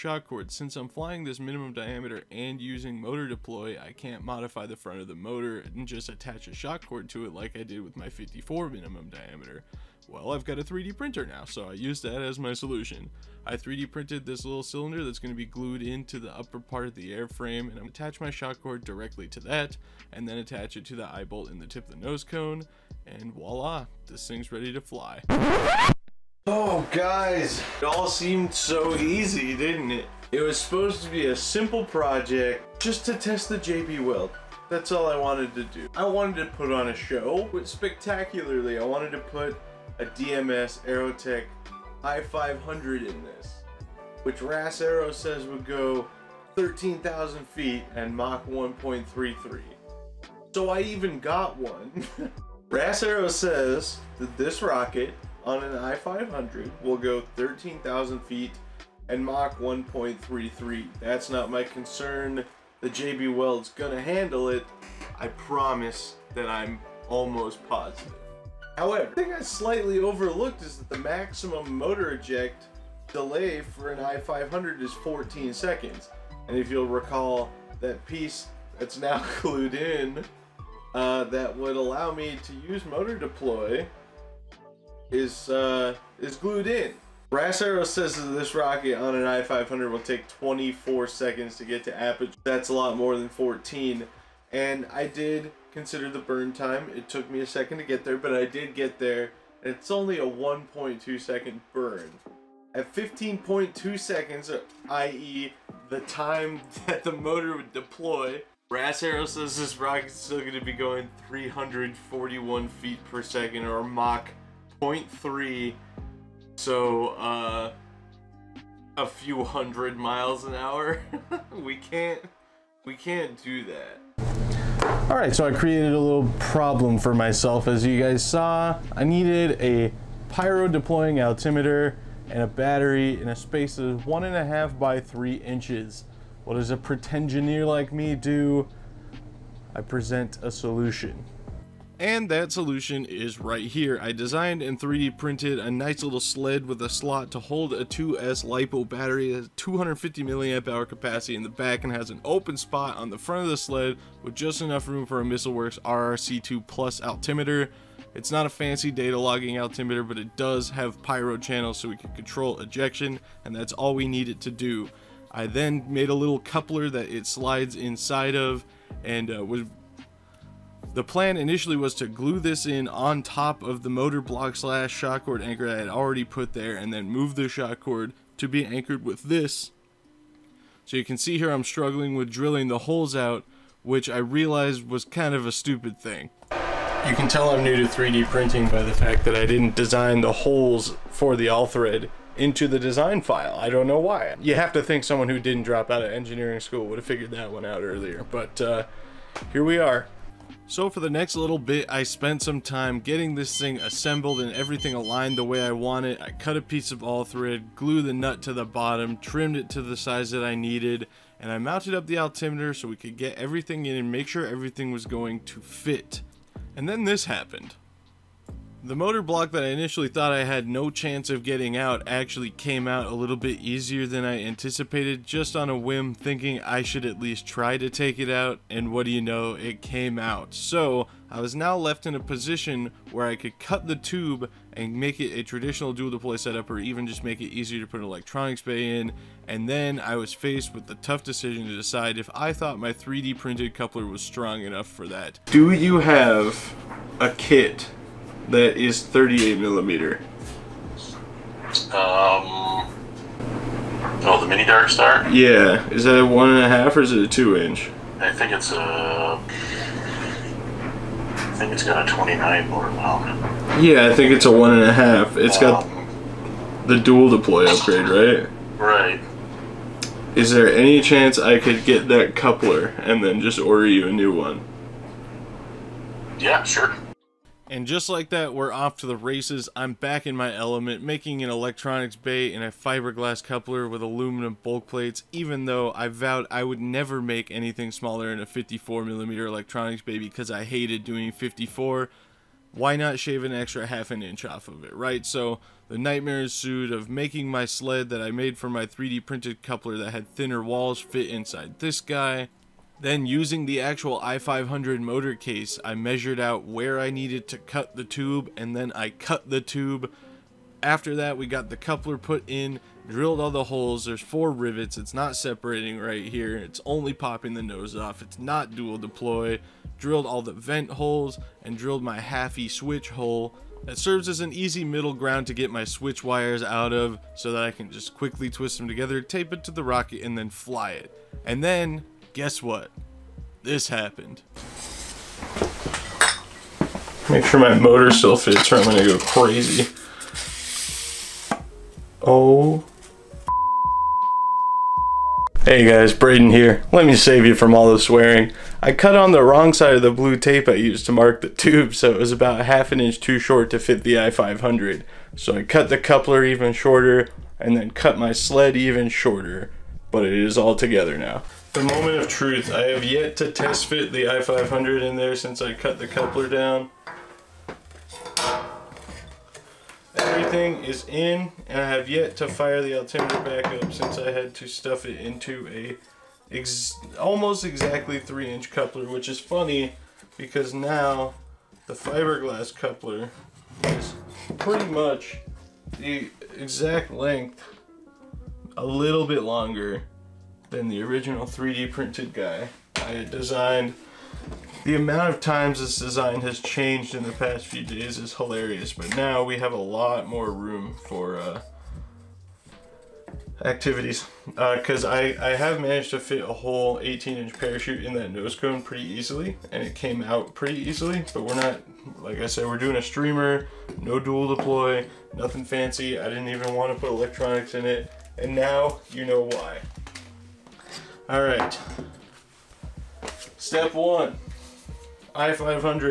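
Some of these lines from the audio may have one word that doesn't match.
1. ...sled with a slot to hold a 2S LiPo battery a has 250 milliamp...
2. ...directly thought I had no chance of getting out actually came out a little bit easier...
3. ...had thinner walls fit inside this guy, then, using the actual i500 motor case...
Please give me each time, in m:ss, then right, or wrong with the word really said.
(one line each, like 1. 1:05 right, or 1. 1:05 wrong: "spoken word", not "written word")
1. 2:26 right
2. 3:39 wrong: "initially", not "directly"
3. 5:00 right.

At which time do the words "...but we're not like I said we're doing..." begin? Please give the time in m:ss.
6:51.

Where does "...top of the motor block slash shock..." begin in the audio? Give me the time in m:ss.
2:53.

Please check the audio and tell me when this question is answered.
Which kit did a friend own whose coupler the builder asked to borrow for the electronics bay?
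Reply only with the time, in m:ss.
4:14.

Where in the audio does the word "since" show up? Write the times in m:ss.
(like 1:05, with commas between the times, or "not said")
0:00, 6:05, 6:13.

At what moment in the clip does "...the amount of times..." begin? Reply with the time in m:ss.
6:34.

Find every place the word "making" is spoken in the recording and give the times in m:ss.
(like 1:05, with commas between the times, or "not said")
4:41, 4:57.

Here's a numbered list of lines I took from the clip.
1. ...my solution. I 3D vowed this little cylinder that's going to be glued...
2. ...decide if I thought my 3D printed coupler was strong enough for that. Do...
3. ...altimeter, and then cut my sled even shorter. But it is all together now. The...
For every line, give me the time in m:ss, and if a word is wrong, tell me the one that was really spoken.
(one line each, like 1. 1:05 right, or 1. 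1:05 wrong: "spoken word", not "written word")
1. 0:12 wrong: "printed", not "vowed"
2. 4:01 right
3. 5:56 wrong: "shorter", not "altimeter".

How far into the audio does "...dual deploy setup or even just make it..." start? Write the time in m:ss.
3:55.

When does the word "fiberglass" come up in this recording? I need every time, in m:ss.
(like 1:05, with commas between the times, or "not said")
4:42, 6:21.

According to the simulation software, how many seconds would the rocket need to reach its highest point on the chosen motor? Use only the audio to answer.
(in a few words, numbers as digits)
24.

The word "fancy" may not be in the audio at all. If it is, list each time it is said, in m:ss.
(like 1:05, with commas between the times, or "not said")
2:38, 6:55.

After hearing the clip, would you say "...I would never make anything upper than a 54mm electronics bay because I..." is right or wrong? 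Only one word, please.
wrong.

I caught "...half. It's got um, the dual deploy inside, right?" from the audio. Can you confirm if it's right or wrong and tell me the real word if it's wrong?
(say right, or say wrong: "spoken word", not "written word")
wrong: "upgrade", not "inside".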